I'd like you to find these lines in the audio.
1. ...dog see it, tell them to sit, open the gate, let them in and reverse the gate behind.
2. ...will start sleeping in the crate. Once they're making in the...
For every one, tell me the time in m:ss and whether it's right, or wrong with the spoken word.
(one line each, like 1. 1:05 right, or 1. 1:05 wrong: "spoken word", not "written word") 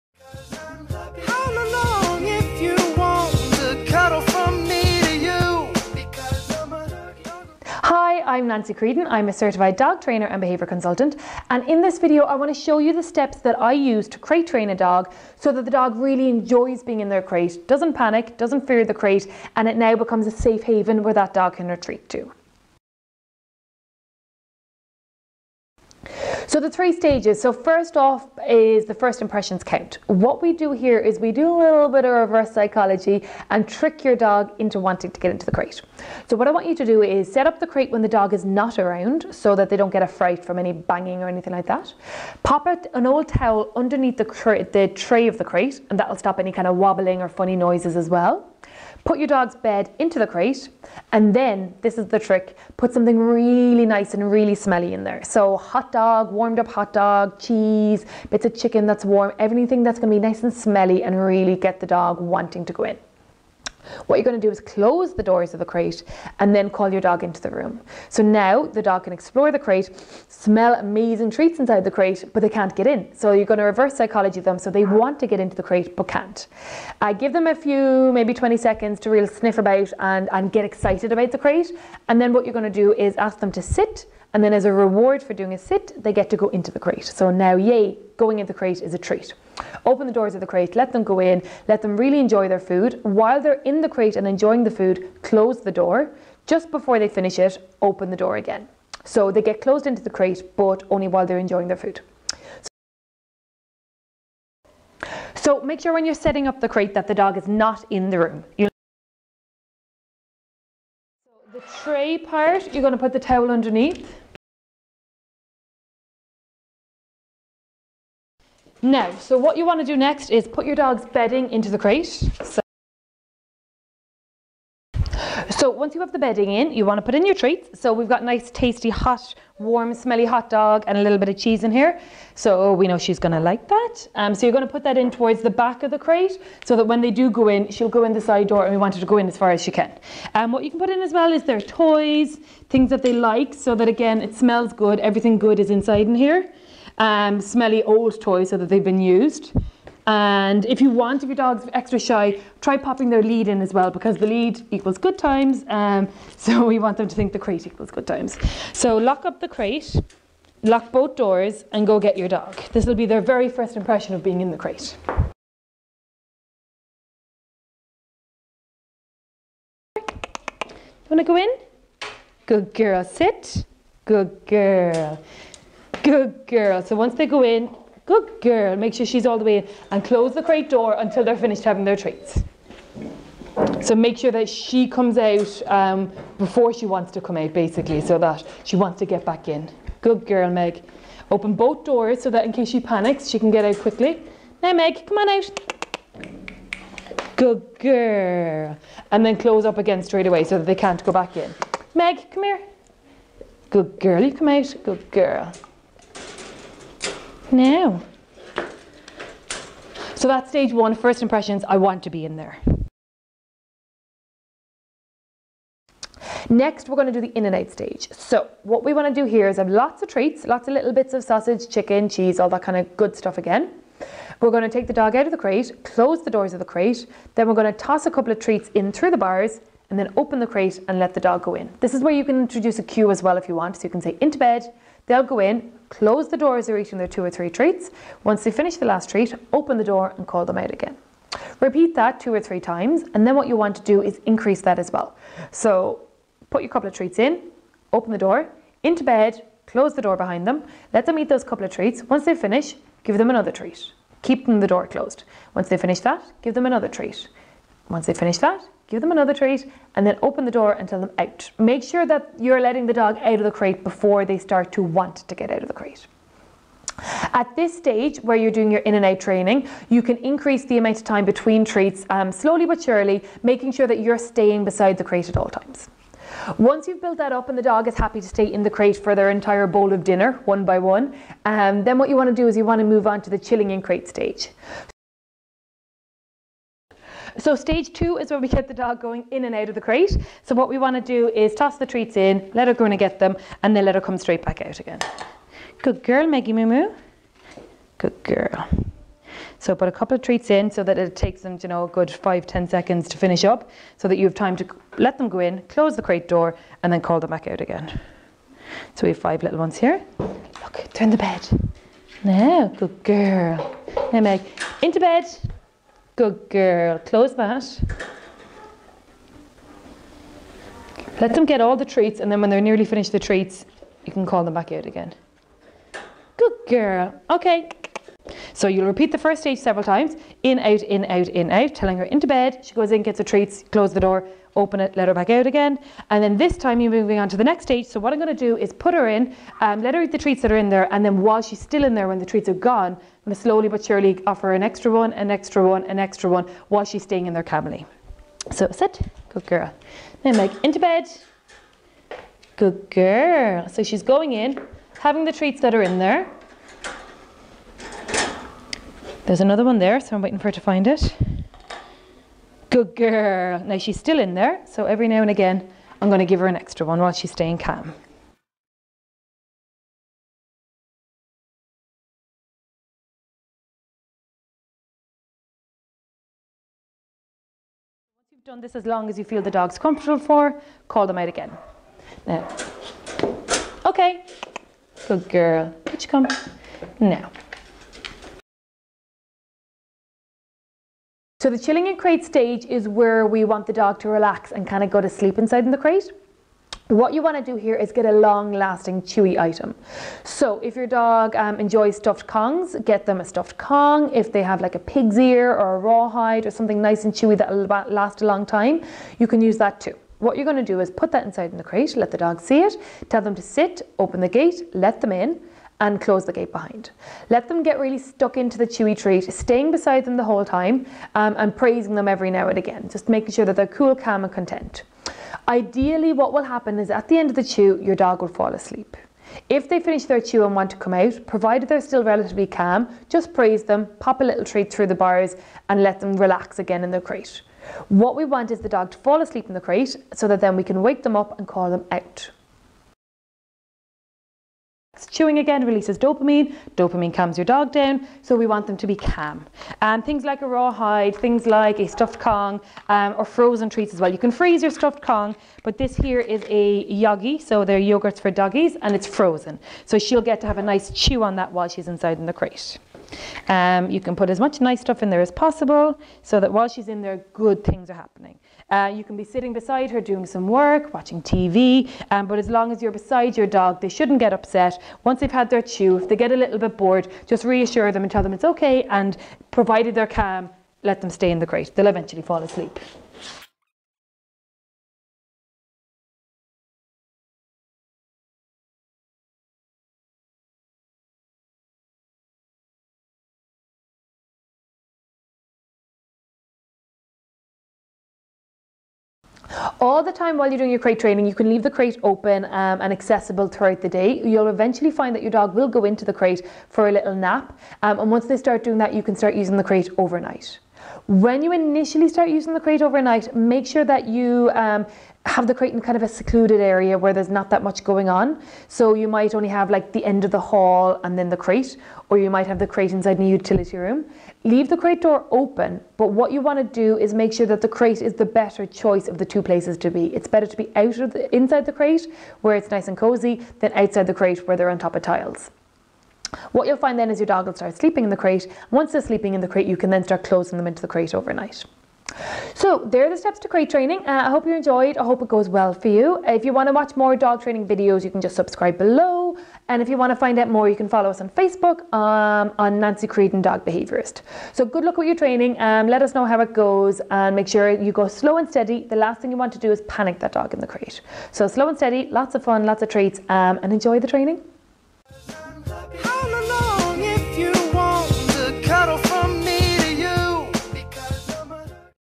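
1. 6:52 wrong: "close", not "reverse"
2. 8:57 wrong: "sleeping", not "making".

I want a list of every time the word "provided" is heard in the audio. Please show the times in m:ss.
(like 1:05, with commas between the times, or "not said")
7:11, 7:59.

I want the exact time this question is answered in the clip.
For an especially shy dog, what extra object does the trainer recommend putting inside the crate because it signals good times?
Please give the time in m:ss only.
2:33.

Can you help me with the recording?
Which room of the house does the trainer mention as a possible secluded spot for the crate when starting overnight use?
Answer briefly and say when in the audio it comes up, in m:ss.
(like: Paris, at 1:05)
utility room, at 8:43.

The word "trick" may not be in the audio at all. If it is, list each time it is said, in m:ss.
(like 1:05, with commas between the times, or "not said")
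0:33, 0:52.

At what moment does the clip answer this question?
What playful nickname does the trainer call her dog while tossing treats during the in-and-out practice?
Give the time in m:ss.
4:56.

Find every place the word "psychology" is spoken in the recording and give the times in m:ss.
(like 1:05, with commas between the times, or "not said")
0:32, 1:13.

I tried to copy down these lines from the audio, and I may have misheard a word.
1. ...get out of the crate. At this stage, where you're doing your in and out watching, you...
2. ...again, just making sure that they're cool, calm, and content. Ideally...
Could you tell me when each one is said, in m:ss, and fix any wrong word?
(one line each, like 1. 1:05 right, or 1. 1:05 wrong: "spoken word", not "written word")
1. 4:25 wrong: "training", not "watching"
2. 7:02 right.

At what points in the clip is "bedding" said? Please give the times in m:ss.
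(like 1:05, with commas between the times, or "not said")
2:01, 2:06.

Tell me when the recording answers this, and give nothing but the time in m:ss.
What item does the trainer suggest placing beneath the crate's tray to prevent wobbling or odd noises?
0:42.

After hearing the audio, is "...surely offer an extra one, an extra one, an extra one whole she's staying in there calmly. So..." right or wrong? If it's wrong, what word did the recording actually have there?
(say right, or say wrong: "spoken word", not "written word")
wrong: "while", not "whole".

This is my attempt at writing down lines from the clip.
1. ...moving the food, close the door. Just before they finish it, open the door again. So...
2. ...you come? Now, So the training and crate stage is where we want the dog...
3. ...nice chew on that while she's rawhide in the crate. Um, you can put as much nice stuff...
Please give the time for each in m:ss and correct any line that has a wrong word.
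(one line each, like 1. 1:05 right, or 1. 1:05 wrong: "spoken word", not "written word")
1. 1:34 wrong: "enjoying", not "moving"
2. 6:26 wrong: "chilling", not "training"
3. 7:40 wrong: "inside", not "rawhide".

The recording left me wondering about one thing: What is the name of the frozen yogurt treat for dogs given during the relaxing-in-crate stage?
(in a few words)
a yogi.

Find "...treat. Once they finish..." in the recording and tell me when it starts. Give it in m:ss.
4:16.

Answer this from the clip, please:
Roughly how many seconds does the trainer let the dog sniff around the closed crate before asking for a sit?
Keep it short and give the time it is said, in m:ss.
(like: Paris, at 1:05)
20 seconds, at 1:18.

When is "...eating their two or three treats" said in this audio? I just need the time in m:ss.
3:56.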